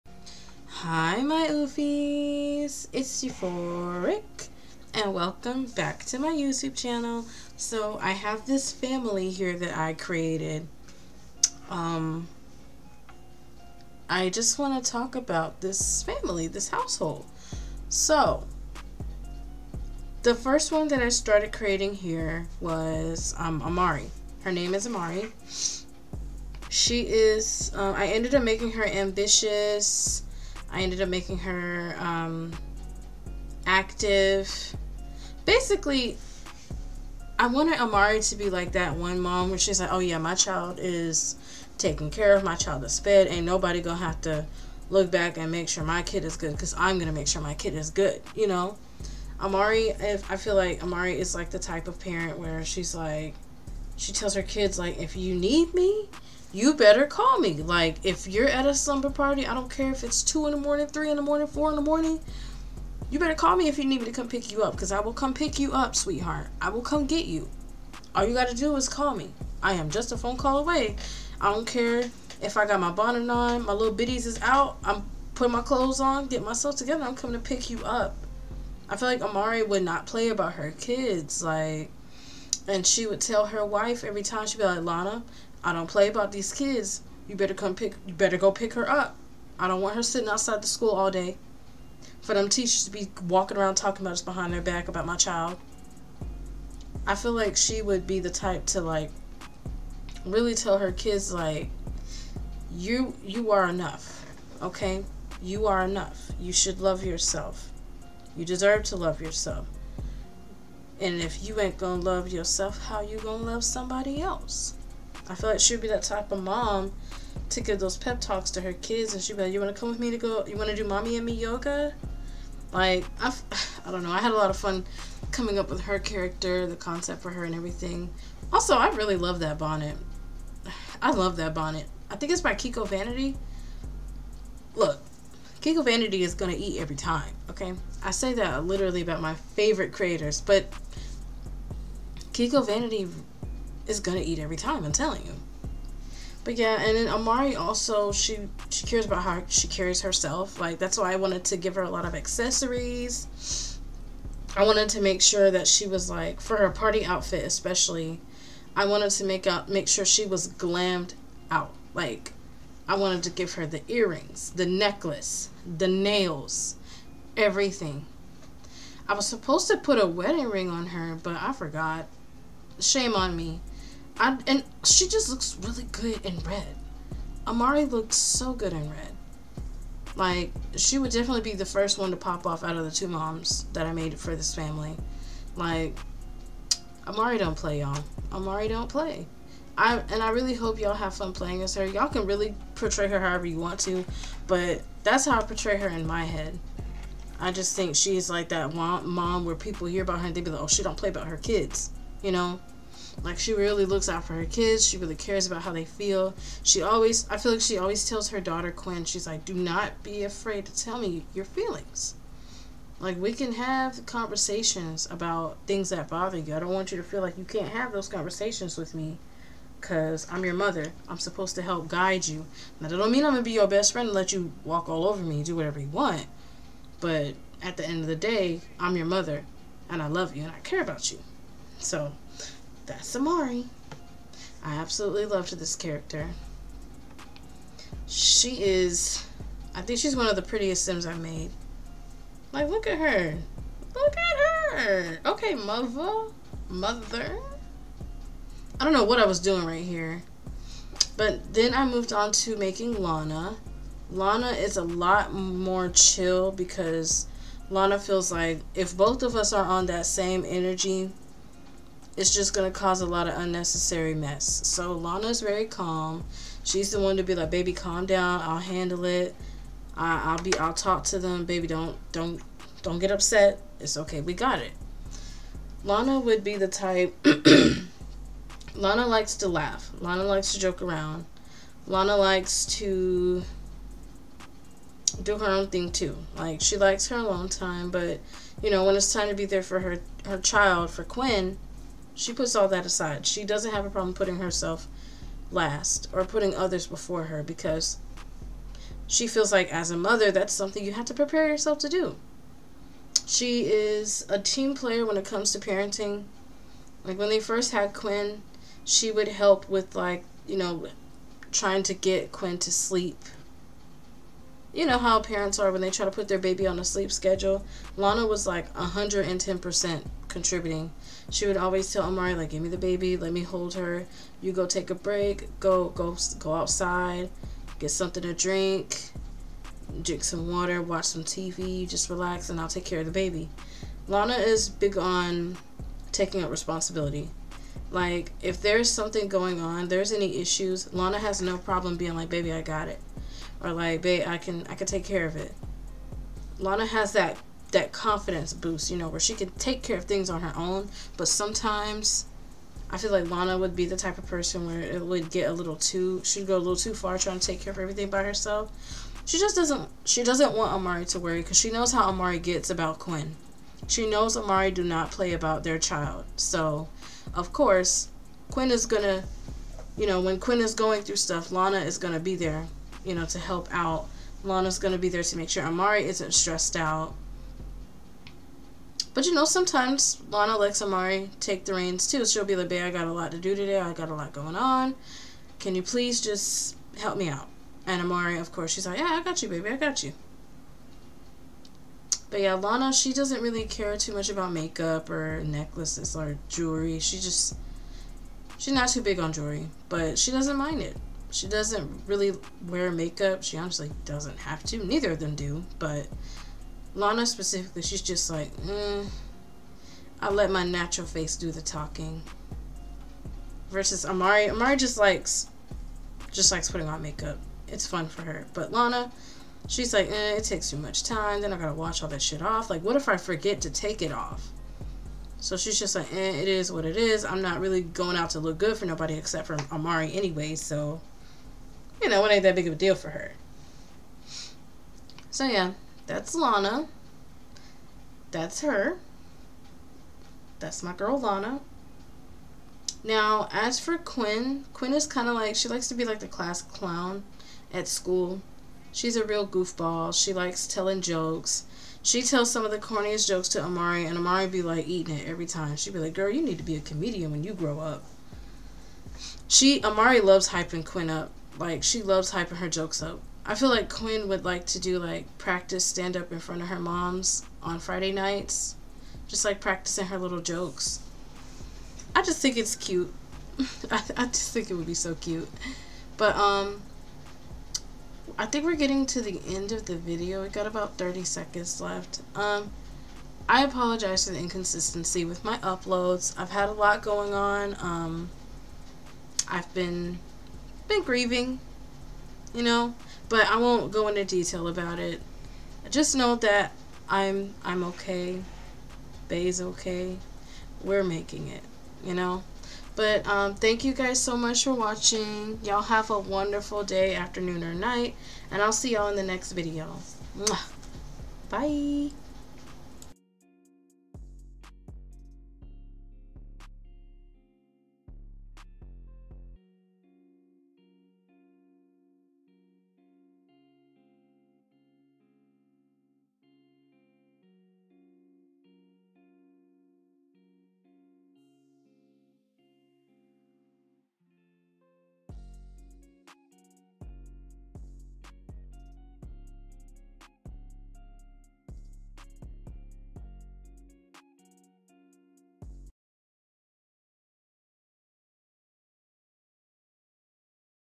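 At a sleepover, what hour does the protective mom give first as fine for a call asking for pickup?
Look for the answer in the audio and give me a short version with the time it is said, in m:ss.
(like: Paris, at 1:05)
2 in the morning, at 1:00.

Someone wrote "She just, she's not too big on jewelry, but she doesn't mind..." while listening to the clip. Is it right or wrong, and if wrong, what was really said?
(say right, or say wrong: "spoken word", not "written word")
right.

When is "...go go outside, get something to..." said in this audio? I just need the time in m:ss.
5:25.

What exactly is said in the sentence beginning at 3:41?
I'm supposed to help guide you.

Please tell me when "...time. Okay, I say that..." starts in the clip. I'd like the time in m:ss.
2:16.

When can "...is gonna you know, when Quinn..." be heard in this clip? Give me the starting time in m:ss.
6:08.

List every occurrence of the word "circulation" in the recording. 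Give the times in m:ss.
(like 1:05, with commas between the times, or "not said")
not said.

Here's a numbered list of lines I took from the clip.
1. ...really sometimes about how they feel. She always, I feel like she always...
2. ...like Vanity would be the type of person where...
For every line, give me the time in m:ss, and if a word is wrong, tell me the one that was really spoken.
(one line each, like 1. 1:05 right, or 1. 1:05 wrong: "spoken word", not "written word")
1. 3:24 wrong: "cares", not "sometimes"
2. 5:53 wrong: "Lana", not "Vanity".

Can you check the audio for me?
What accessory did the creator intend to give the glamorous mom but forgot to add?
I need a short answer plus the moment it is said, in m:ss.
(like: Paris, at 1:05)
wedding ring, at 2:50.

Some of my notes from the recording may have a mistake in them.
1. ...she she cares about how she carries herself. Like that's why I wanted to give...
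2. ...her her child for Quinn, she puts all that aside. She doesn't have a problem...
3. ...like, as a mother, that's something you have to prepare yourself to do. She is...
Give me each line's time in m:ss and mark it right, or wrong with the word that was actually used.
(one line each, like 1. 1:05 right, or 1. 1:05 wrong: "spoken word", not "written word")
1. 2:28 right
2. 4:49 right
3. 4:59 right.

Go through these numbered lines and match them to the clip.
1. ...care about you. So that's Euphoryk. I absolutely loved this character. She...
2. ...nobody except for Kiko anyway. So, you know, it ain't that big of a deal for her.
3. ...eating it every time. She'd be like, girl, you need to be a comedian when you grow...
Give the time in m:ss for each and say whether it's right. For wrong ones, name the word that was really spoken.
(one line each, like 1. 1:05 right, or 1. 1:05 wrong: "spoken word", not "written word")
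1. 3:50 wrong: "Amari", not "Euphoryk"
2. 7:08 wrong: "Amari", not "Kiko"
3. 7:34 right.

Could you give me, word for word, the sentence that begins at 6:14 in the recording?
Lana's gonna be there to make sure Amari isn't stressed out but you know, sometimes Lana lets Amari take the reins too.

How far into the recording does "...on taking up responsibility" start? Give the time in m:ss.
5:34.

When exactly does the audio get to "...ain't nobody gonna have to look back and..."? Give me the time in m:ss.
0:43.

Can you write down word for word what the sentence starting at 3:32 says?
Like we can have conversations about things that bother you.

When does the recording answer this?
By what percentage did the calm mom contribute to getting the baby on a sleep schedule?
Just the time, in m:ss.
5:18.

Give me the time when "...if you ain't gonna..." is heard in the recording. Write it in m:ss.
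1:51.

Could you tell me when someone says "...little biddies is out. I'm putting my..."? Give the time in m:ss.
1:13.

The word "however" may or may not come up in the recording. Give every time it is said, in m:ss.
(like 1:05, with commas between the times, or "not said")
3:13.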